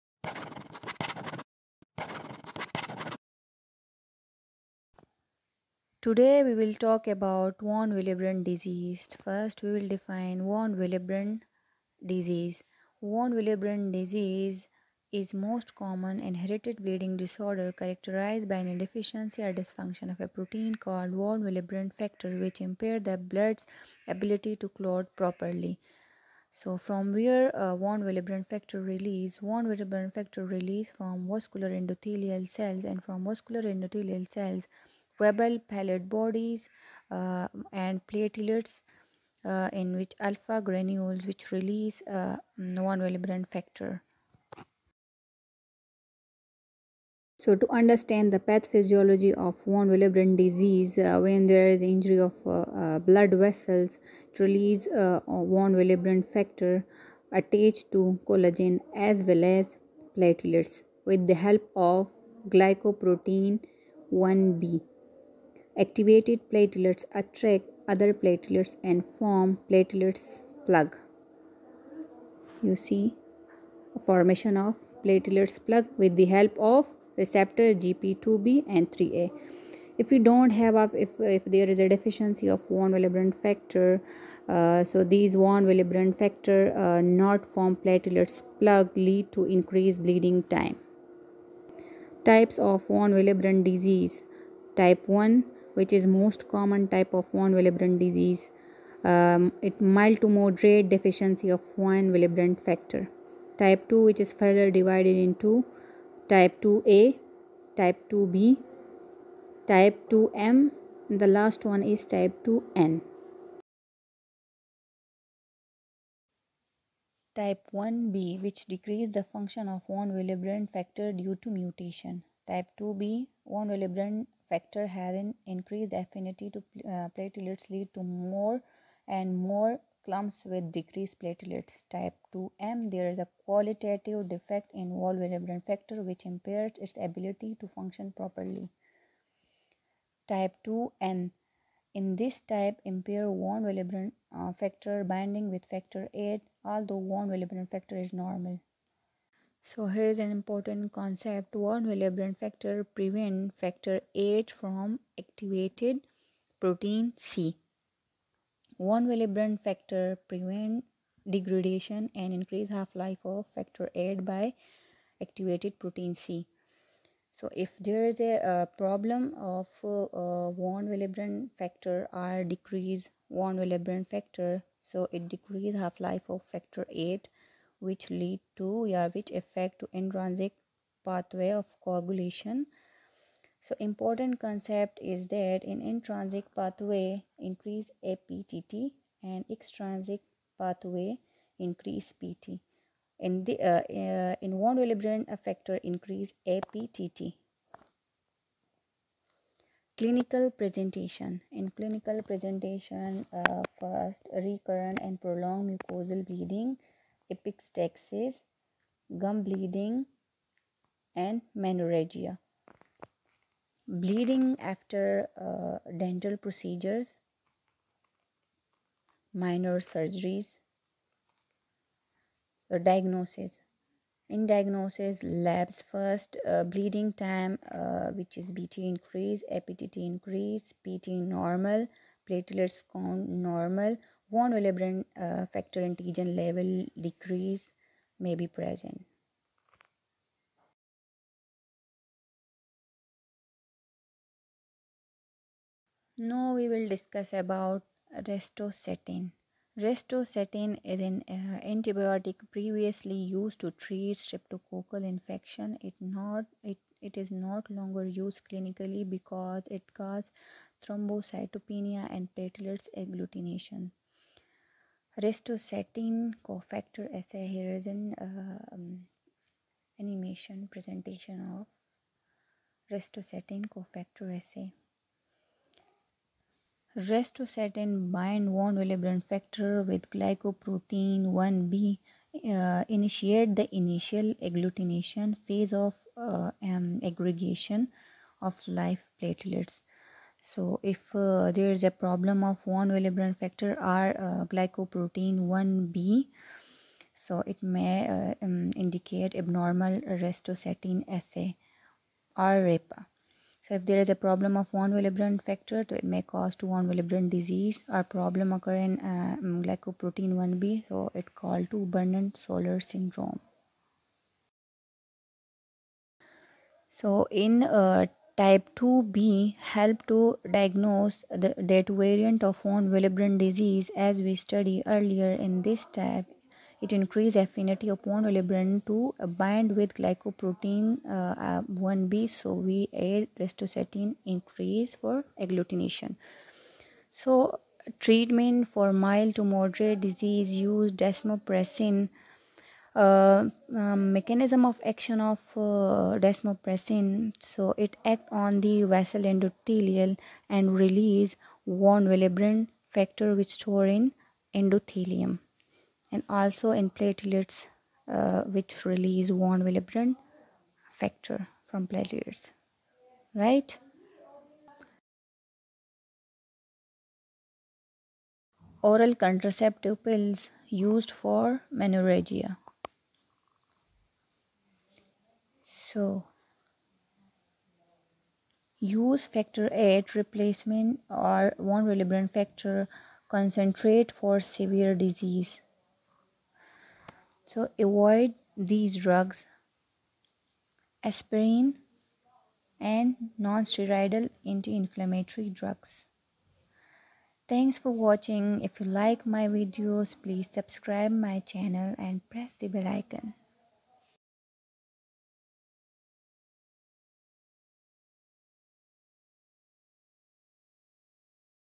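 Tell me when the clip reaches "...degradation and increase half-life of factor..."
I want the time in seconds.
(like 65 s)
161 s.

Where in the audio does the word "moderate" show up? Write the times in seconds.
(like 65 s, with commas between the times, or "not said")
100 s, 339 s.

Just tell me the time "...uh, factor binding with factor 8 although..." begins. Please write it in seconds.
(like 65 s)
144 s.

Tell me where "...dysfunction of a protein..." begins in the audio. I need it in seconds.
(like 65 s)
19 s.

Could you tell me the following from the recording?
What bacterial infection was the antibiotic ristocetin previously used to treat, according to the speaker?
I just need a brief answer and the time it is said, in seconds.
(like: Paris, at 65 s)
streptococcal infection, at 254 s.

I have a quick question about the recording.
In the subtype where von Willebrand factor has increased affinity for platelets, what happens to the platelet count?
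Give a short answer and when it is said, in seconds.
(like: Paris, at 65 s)
decreased platelets, at 130 s.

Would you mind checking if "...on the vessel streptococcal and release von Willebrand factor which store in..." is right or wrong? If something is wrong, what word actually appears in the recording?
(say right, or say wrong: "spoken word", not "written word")
wrong: "endothelial", not "streptococcal".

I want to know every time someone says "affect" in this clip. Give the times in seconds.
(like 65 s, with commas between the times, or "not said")
179 s.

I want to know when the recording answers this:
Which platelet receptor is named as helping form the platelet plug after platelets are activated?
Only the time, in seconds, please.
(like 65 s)
77 s.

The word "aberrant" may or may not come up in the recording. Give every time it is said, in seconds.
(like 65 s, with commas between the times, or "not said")
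152 s.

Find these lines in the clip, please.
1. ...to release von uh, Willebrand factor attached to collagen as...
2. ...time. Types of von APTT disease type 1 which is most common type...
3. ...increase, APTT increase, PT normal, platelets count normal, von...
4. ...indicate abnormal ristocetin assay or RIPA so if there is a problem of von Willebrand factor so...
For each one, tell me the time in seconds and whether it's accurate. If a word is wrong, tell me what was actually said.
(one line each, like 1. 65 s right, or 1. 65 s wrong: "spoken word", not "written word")
1. 54 s right
2. 90 s wrong: "Willebrand", not "APTT"
3. 228 s right
4. 298 s right.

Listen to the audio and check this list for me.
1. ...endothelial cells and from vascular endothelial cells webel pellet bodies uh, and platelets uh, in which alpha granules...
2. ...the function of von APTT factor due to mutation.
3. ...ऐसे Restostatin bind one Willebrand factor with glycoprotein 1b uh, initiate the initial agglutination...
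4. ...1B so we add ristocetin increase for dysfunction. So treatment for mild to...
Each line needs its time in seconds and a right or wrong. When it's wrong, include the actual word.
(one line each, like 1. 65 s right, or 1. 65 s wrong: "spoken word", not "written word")
1. 31 s right
2. 119 s wrong: "Willebrand", not "APTT"
3. 274 s right
4. 331 s wrong: "agglutination", not "dysfunction".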